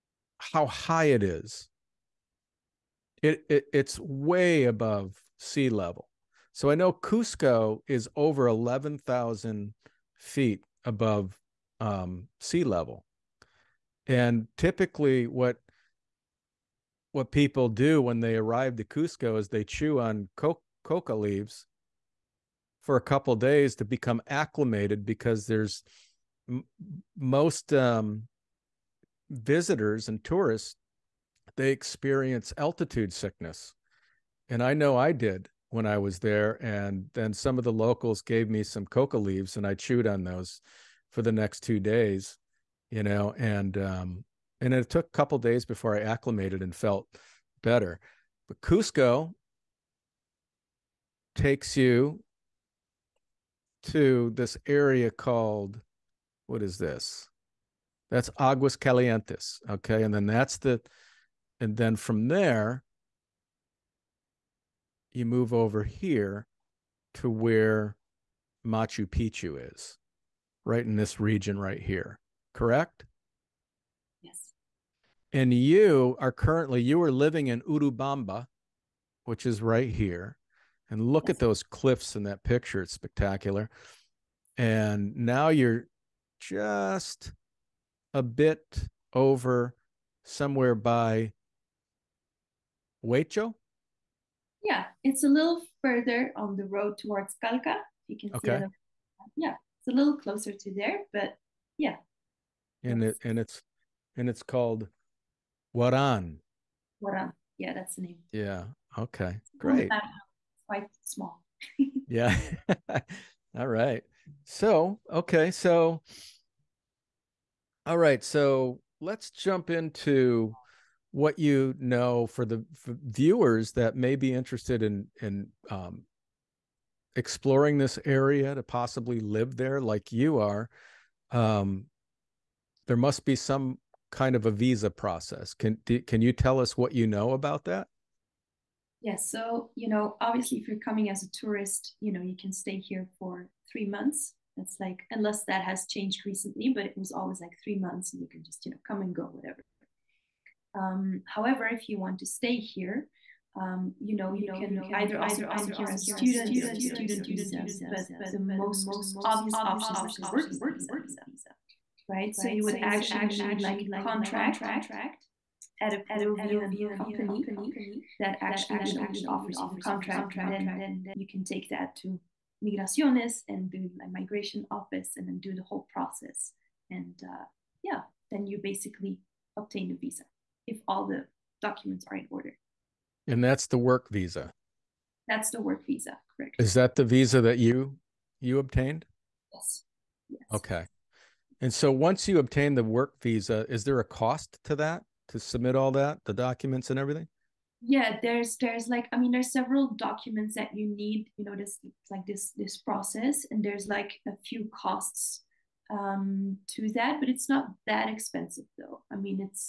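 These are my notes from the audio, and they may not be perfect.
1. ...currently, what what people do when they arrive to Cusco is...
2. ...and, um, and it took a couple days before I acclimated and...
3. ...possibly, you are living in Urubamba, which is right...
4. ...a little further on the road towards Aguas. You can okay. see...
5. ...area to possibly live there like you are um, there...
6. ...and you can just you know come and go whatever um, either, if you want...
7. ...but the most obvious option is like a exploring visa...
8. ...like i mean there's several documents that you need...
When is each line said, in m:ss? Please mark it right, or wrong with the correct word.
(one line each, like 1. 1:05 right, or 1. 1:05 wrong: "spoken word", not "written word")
1. 0:14 wrong: "typically", not "currently"
2. 0:43 right
3. 1:16 wrong: "currently", not "possibly"
4. 1:35 wrong: "Calca", not "Aguas"
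5. 2:08 right
6. 2:28 wrong: "however", not "either"
7. 2:37 wrong: "working", not "exploring"
8. 3:18 right.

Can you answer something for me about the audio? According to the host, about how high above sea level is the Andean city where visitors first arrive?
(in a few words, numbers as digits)
over 11,000 feet.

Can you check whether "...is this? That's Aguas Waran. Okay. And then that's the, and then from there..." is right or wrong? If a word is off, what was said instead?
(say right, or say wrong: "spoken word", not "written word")
wrong: "Calientes", not "Waran".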